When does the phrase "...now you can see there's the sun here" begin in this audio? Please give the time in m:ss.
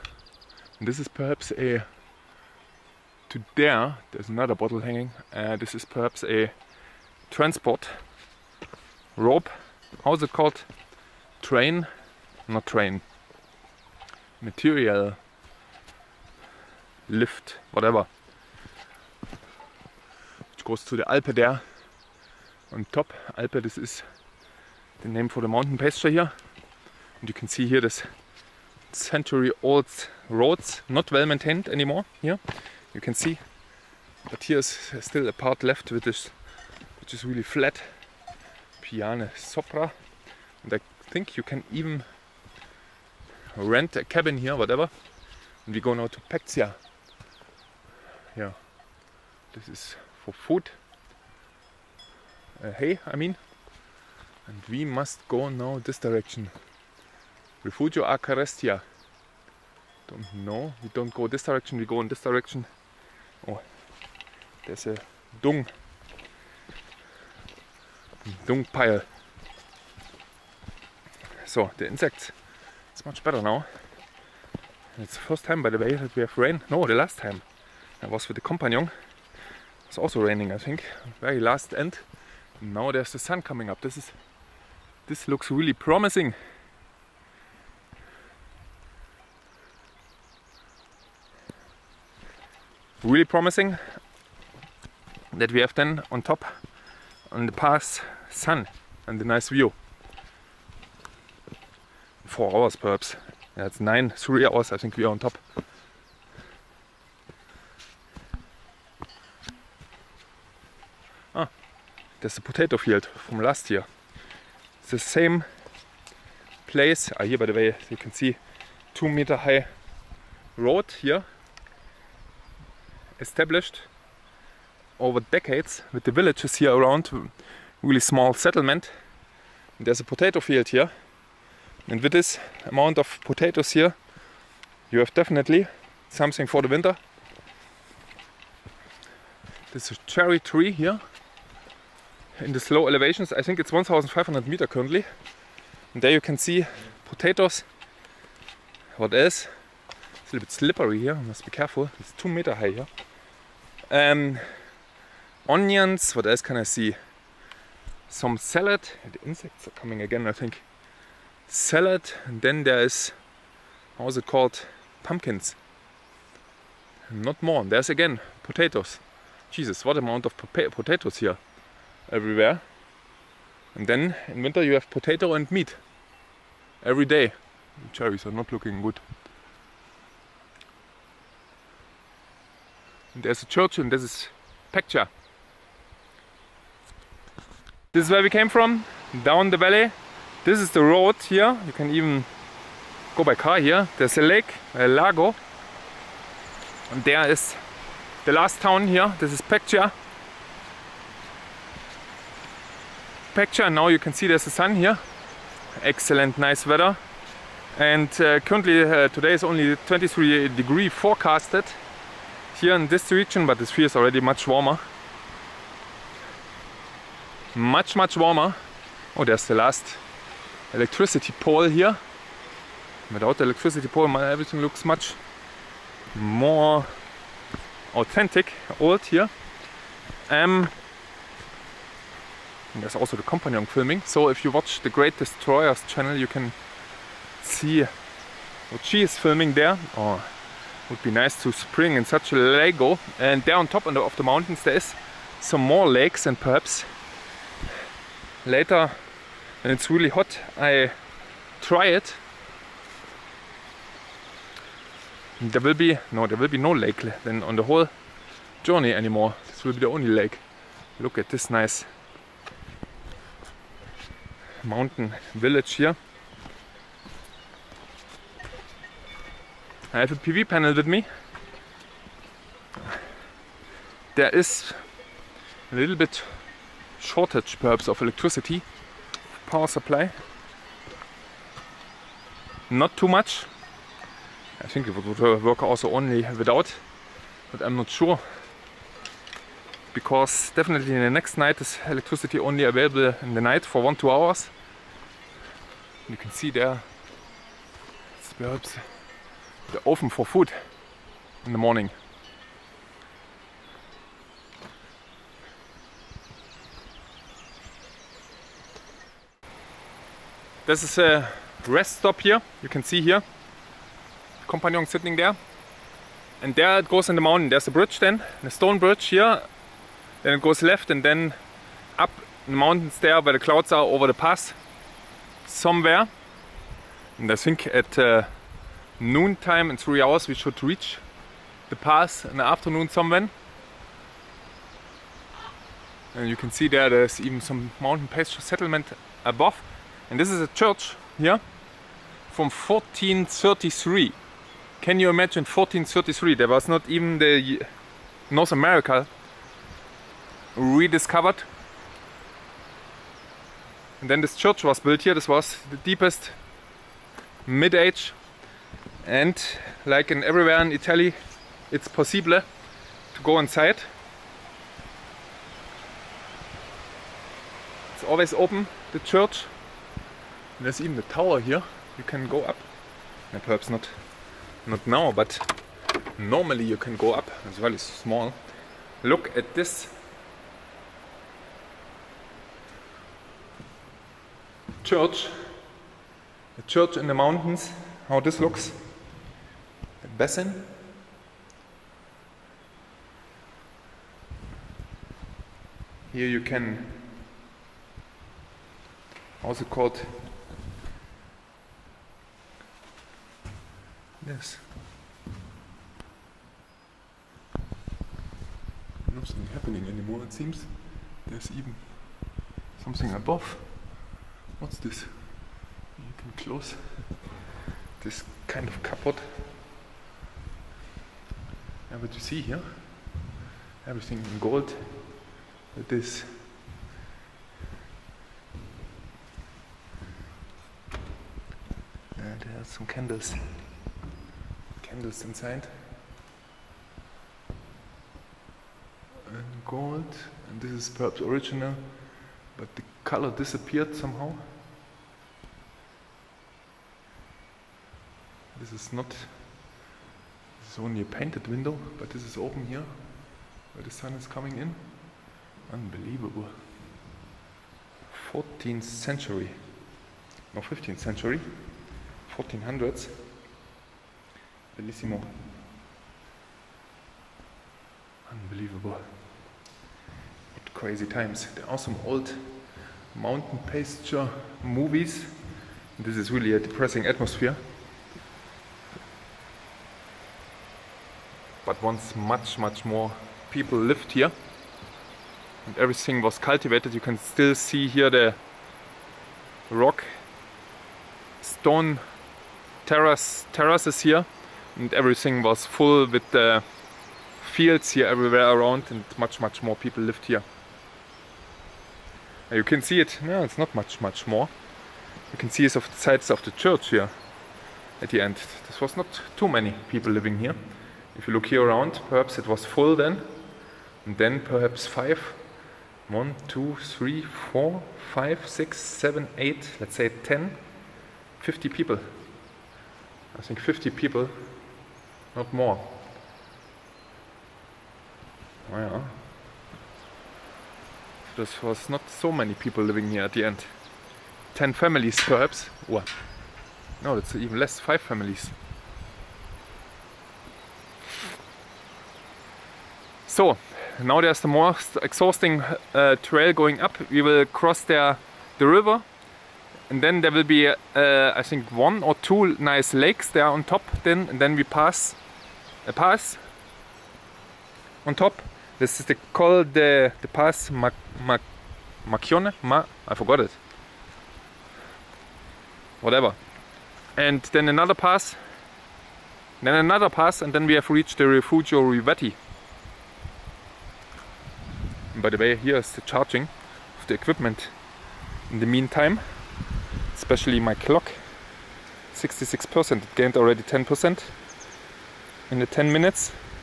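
3:23.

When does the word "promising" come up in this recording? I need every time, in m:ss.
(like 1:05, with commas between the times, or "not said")
1:25, 1:33.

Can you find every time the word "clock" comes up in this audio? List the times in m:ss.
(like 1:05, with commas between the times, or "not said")
9:40.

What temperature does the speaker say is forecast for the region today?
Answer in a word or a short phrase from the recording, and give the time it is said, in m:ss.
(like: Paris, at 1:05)
23 degrees, at 3:29.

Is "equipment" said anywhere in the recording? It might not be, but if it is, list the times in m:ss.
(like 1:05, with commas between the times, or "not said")
9:37.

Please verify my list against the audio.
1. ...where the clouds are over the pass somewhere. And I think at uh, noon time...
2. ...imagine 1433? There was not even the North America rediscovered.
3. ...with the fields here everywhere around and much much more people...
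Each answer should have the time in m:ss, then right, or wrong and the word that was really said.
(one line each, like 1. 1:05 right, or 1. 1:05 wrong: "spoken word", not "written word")
1. 5:23 right
2. 5:45 right
3. 8:16 right.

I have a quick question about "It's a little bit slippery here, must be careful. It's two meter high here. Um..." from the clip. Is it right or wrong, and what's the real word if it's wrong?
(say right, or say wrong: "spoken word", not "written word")
right.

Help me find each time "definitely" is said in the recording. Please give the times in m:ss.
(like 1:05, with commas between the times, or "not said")
2:15, 4:50.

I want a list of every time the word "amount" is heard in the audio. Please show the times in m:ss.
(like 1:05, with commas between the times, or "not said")
2:12, 2:49.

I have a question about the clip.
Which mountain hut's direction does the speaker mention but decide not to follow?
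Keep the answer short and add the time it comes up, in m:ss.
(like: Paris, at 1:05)
Refugio Acarestia, at 0:57.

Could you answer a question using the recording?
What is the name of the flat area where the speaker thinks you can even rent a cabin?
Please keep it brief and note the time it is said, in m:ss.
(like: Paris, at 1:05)
Piane Sopra, at 0:38.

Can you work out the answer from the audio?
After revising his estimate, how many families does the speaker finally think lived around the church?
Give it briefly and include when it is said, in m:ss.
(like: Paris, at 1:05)
5 families, at 8:57.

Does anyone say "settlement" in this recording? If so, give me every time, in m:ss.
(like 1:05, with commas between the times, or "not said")
2:08, 5:38.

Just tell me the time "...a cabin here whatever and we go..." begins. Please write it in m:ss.
0:43.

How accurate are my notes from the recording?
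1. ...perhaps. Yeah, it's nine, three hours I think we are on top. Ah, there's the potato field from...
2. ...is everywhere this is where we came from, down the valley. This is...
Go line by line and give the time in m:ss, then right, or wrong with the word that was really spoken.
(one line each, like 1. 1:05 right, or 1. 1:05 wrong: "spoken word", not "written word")
1. 1:42 right
2. 3:04 wrong: "picture", not "everywhere".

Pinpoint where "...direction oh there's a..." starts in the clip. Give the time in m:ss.
1:02.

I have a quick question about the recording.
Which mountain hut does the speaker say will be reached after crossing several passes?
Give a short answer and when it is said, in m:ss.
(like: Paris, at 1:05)
Refugio Rivetti, at 9:31.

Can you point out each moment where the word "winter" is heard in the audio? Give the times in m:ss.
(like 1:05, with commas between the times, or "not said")
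2:16, 2:54.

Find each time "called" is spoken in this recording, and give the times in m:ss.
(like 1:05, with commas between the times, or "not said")
0:10, 2:44, 6:39, 9:19.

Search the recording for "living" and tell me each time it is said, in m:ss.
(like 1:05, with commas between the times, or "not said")
8:30, 8:52.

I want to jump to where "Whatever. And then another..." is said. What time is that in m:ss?
9:26.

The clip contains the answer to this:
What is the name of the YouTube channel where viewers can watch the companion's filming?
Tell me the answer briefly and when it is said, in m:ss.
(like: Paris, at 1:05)
Great Destroyers, at 3:54.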